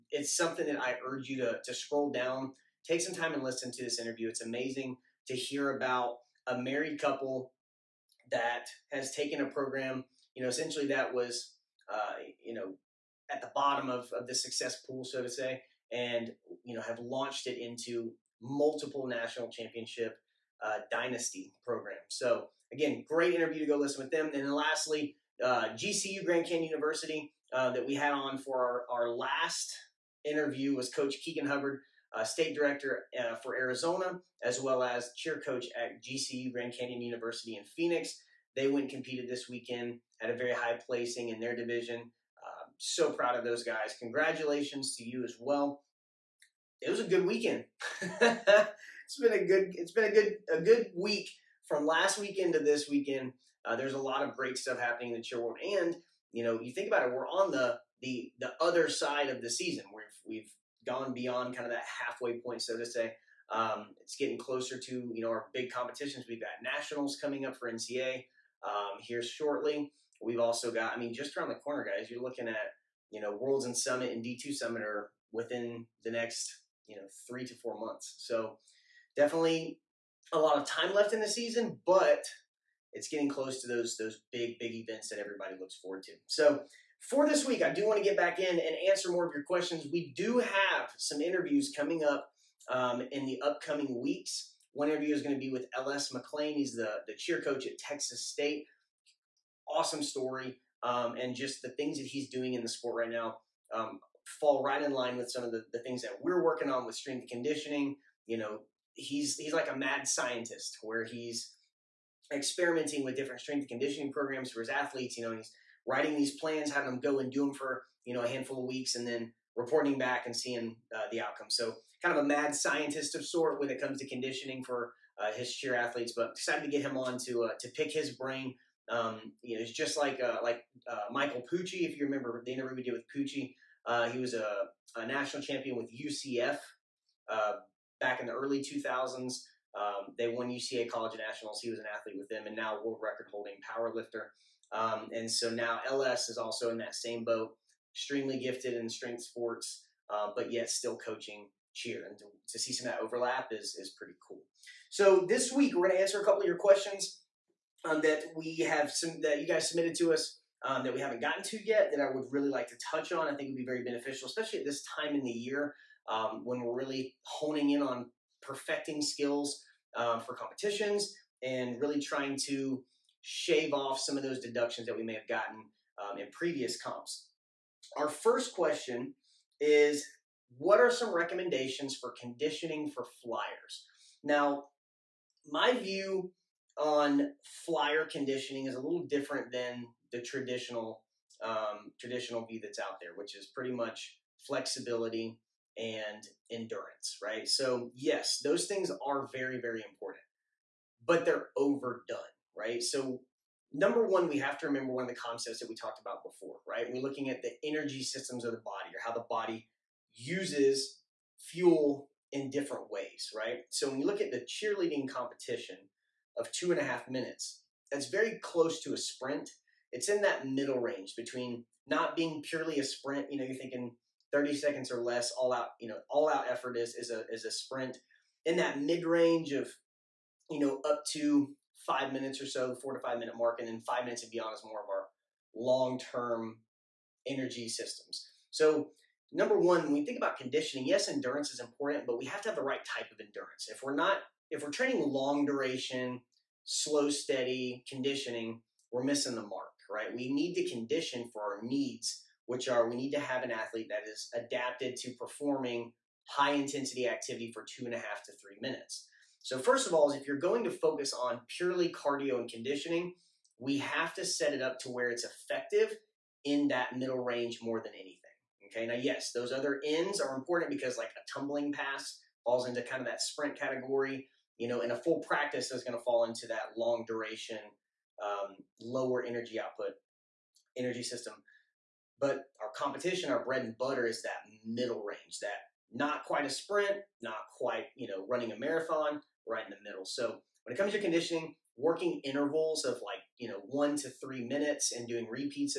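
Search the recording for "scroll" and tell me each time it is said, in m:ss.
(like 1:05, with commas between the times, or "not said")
0:01.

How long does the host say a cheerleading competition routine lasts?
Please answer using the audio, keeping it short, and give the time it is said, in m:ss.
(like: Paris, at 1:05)
2.5 minutes, at 3:36.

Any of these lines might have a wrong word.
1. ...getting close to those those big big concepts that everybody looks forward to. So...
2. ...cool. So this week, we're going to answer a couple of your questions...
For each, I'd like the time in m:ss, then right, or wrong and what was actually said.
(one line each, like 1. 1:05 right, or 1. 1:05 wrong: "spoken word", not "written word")
1. 1:23 wrong: "events", not "concepts"
2. 2:34 right.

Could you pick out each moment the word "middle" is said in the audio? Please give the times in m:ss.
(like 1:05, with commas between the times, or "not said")
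3:40, 4:26, 4:44, 4:49.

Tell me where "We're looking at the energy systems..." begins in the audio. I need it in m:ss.
3:26.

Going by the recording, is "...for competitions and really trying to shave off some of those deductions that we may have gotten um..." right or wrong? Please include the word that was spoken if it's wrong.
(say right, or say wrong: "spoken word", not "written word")
right.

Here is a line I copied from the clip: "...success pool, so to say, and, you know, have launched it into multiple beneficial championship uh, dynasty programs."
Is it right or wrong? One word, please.
wrong.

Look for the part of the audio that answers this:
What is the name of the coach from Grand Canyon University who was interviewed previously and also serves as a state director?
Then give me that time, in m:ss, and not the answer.
0:31.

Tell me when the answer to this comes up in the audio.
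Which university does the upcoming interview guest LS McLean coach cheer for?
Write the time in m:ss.
1:37.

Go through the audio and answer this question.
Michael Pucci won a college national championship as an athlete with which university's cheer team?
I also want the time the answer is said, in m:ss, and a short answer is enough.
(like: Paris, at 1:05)
UCF, at 2:15.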